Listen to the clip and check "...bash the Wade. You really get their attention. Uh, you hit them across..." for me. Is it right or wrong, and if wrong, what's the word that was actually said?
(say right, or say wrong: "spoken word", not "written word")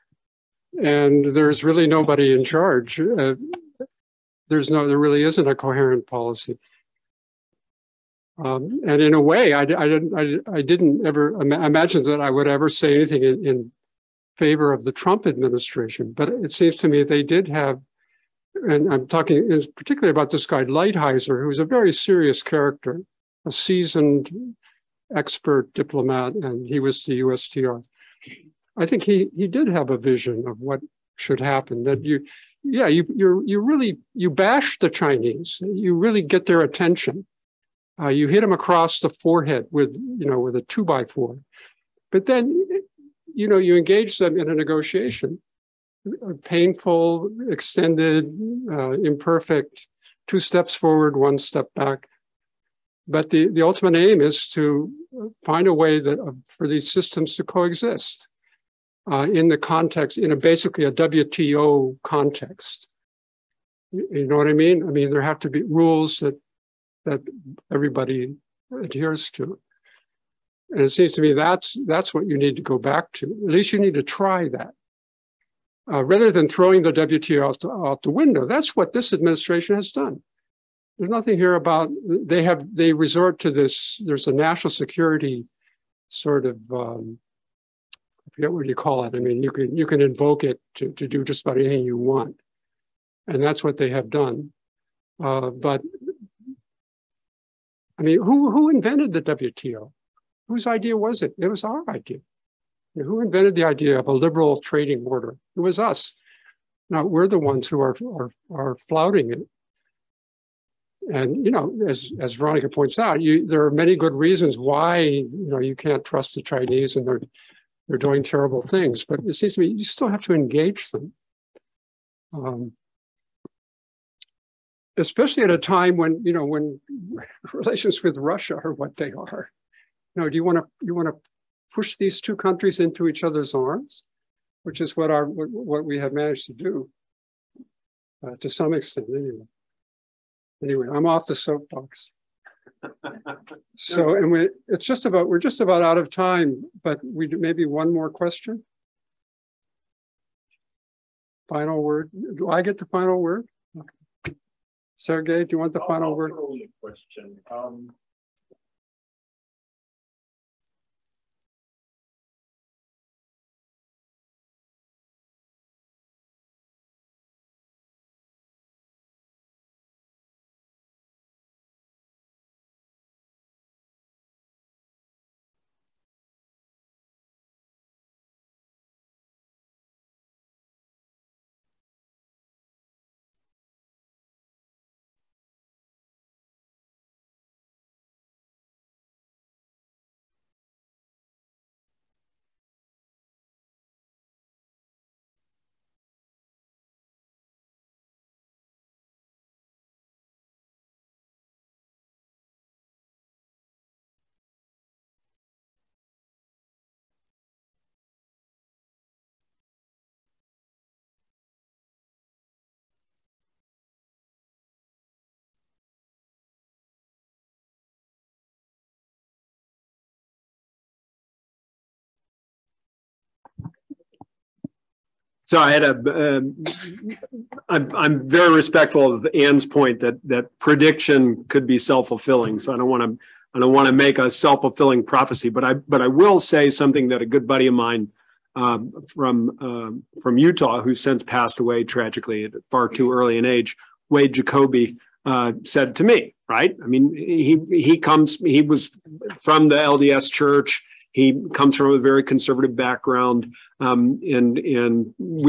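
wrong: "Chinese", not "Wade".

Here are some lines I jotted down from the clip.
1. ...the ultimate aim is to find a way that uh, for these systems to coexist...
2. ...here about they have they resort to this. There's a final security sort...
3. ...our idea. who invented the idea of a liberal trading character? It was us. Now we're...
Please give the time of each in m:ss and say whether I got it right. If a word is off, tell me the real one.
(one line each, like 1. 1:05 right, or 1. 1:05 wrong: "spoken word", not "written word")
1. 0:53 right
2. 1:21 wrong: "national", not "final"
3. 1:41 wrong: "order", not "character".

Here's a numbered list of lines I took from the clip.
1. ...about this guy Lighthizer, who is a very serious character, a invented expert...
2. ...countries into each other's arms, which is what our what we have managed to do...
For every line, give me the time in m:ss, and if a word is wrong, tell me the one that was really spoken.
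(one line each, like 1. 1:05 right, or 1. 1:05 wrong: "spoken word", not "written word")
1. 0:20 wrong: "seasoned", not "invented"
2. 2:12 right.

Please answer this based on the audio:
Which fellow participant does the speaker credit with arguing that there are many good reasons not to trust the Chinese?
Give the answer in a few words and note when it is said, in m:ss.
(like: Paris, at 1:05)
Veronica, at 1:52.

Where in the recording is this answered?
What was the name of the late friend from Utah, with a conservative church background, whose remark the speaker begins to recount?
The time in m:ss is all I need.
4:04.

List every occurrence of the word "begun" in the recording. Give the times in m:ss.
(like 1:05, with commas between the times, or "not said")
not said.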